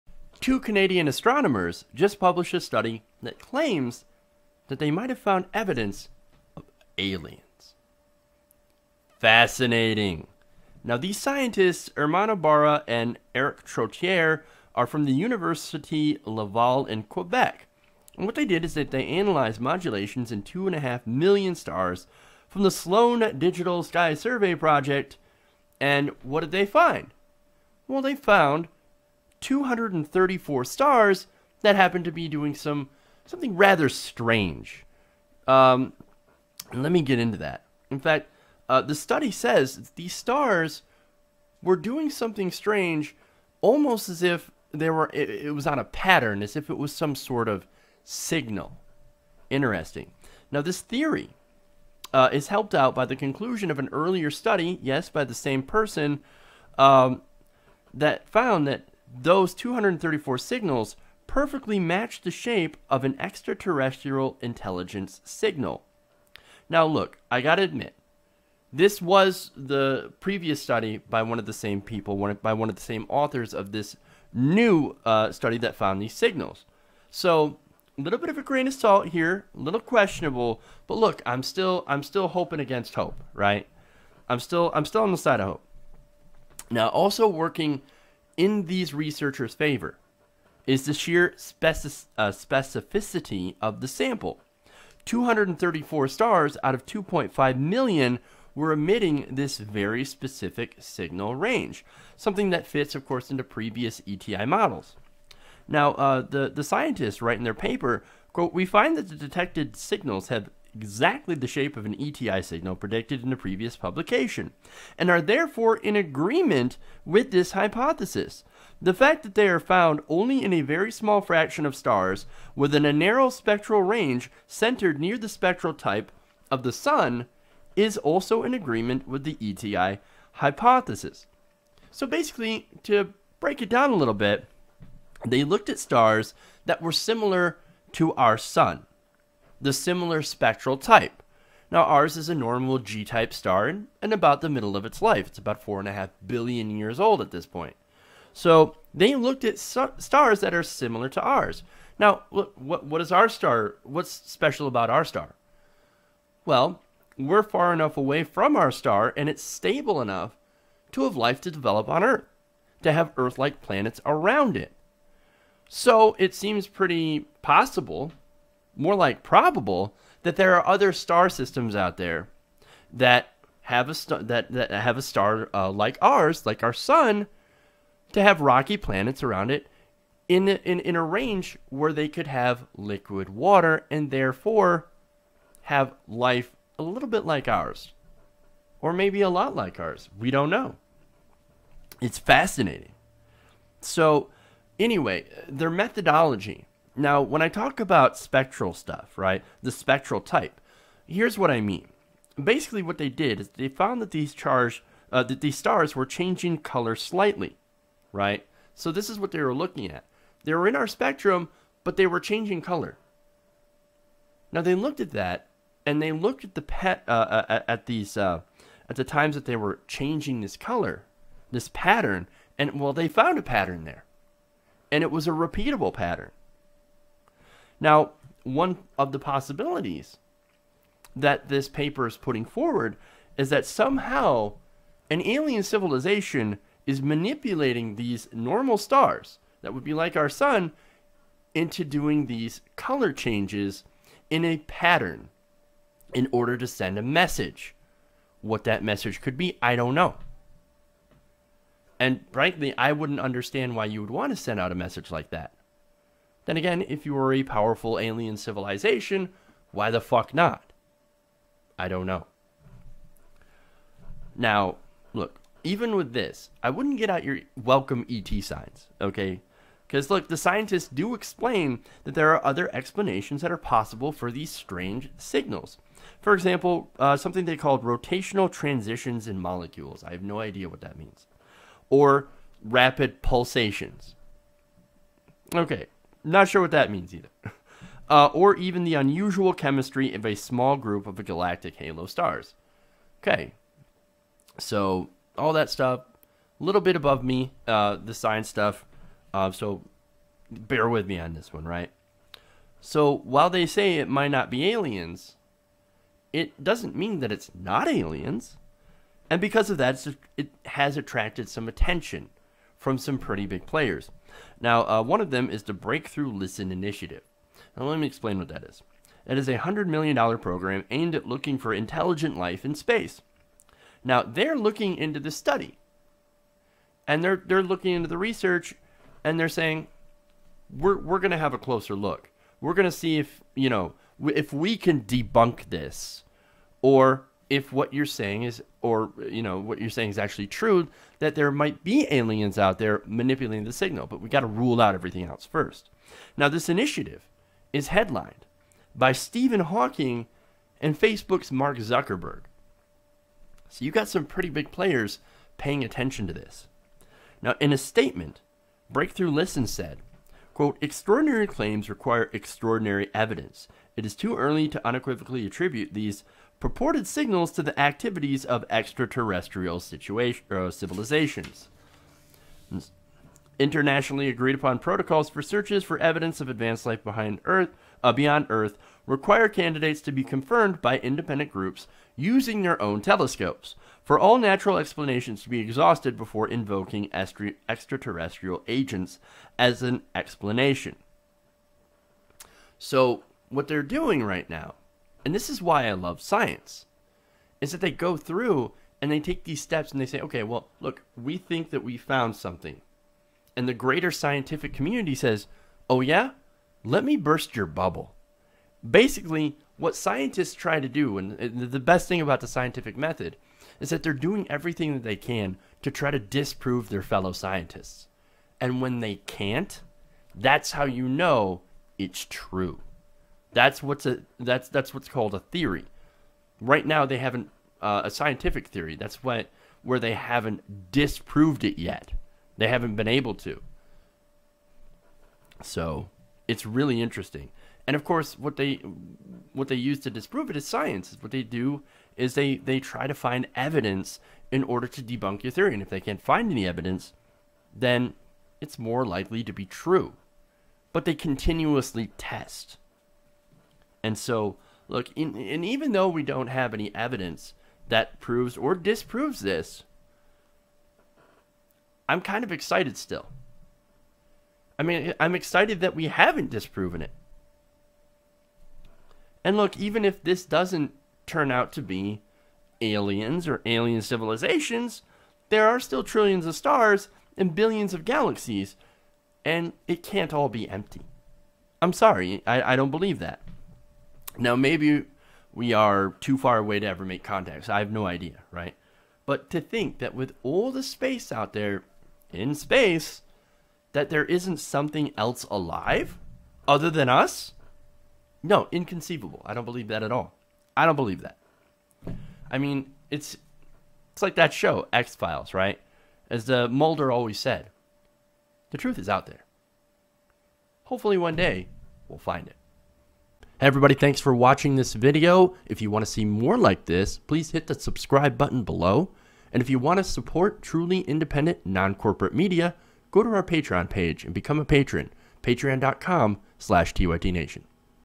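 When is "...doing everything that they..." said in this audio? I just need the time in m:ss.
6:54.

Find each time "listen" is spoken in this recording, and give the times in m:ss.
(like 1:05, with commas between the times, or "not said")
5:16, 5:59.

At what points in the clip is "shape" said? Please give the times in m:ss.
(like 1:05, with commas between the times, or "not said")
1:02, 1:51.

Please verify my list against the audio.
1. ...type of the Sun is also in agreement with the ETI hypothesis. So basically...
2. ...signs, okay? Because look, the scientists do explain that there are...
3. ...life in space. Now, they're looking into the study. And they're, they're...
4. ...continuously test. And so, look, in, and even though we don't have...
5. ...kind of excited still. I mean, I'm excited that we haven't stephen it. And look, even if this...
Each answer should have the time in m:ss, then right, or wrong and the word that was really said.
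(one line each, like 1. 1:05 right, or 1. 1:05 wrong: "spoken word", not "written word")
1. 2:05 right
2. 4:28 right
3. 5:22 right
4. 7:31 right
5. 7:42 wrong: "disproven", not "stephen".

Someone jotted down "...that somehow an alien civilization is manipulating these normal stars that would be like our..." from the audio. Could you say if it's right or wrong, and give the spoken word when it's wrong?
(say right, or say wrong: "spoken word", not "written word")
right.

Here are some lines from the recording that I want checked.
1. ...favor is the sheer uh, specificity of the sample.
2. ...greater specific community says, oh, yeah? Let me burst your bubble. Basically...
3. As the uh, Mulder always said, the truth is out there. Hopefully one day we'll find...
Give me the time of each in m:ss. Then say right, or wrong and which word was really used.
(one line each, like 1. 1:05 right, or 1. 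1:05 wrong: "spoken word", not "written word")
1. 1:29 right
2. 6:43 wrong: "scientific", not "specific"
3. 8:26 right.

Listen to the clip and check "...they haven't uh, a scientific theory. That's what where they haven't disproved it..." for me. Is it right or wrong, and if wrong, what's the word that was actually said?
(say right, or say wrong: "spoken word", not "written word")
right.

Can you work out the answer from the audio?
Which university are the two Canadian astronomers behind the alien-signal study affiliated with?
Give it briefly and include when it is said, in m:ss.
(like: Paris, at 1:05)
University Laval, at 0:15.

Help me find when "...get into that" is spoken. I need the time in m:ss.
0:37.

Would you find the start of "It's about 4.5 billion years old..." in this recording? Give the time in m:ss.
2:25.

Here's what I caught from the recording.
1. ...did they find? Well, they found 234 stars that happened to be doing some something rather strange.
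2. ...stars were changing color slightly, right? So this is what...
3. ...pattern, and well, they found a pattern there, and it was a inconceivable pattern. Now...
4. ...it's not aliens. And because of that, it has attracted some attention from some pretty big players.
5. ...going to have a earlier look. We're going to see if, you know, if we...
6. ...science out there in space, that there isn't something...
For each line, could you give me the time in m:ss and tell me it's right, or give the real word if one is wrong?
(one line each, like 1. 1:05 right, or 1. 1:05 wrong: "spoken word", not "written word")
1. 0:26 right
2. 3:25 right
3. 3:41 wrong: "repeatable", not "inconceivable"
4. 5:07 right
5. 5:31 wrong: "closer", not "earlier"
6. 8:10 wrong: "space", not "science".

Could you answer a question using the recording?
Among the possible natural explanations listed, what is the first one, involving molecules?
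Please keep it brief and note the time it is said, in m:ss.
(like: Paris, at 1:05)
rotational transitions, at 4:37.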